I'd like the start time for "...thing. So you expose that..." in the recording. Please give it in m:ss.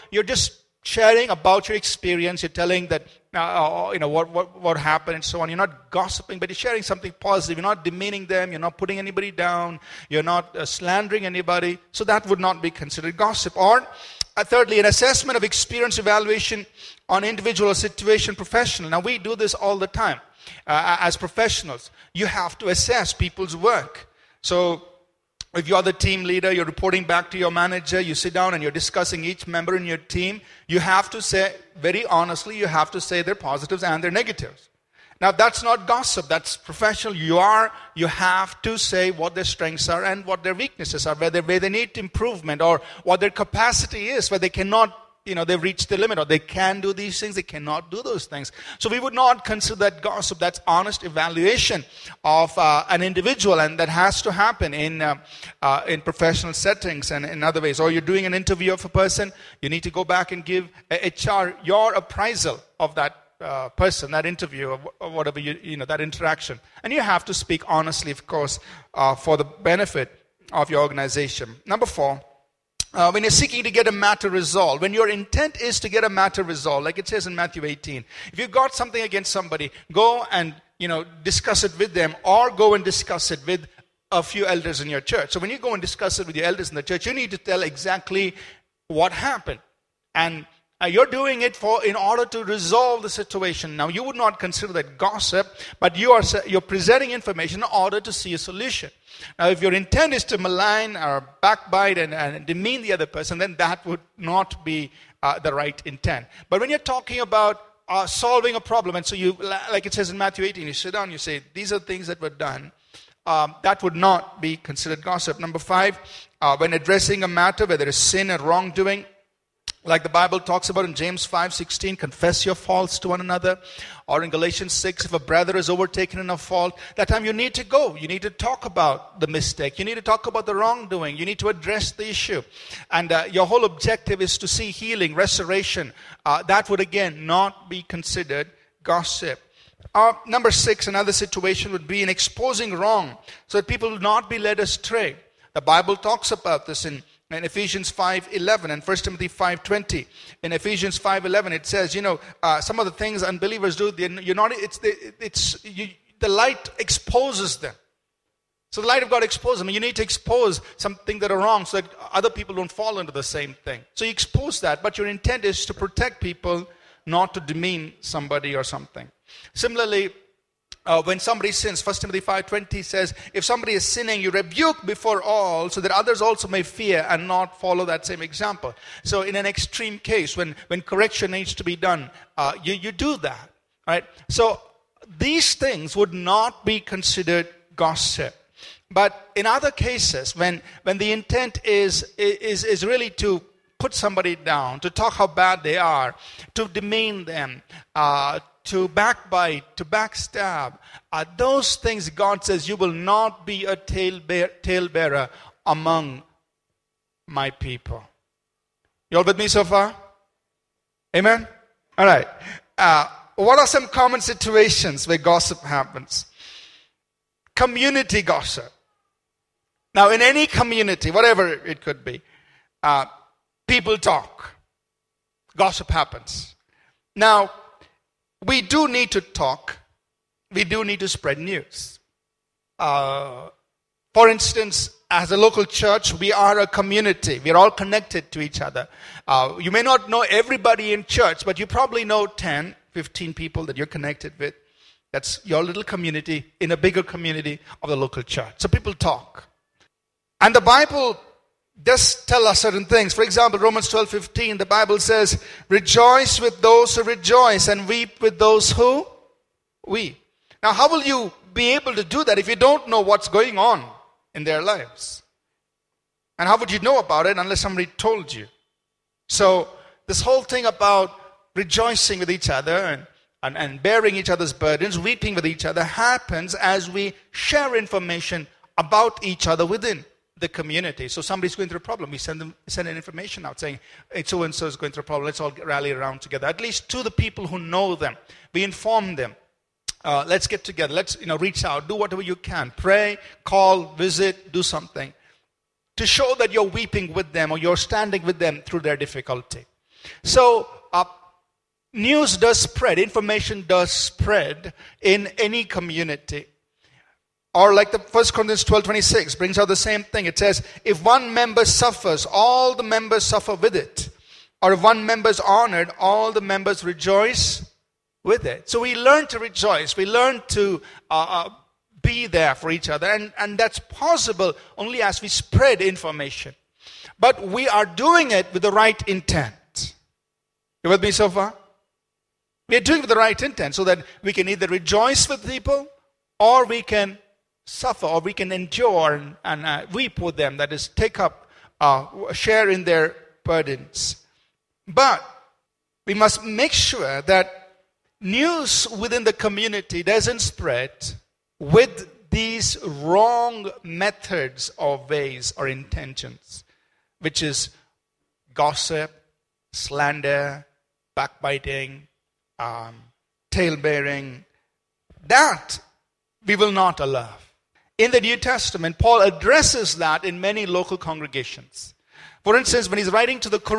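2:43.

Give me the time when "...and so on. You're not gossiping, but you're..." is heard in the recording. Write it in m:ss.
0:05.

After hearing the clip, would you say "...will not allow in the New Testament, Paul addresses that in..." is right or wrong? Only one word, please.
right.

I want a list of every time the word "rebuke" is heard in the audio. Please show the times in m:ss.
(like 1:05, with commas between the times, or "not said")
2:54.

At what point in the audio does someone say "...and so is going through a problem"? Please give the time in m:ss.
4:44.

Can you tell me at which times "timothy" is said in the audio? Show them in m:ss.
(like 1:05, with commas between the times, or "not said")
2:29, 2:51.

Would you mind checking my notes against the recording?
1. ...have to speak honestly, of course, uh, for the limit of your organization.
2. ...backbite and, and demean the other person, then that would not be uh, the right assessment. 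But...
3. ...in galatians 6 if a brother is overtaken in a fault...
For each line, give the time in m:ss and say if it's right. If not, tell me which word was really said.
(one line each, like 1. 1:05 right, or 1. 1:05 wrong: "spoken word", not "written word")
1. 1:07 wrong: "benefit", not "limit"
2. 1:41 wrong: "intent", not "assessment"
3. 2:04 right.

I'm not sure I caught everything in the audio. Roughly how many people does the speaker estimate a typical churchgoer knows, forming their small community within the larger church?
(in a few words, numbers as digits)
10 to 15.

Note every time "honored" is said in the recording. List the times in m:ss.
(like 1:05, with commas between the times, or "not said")
5:15.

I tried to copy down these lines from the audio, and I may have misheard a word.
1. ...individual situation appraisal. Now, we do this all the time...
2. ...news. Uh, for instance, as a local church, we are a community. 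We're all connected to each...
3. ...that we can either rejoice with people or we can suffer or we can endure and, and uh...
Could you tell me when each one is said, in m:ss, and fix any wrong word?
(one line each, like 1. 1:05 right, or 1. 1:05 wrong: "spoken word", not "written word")
1. 0:17 wrong: "professional", not "appraisal"
2. 3:51 right
3. 5:33 right.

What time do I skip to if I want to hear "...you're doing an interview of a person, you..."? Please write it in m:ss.
0:57.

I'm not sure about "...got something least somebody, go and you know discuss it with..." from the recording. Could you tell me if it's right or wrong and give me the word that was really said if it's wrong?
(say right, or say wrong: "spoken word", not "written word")
wrong: "against", not "least".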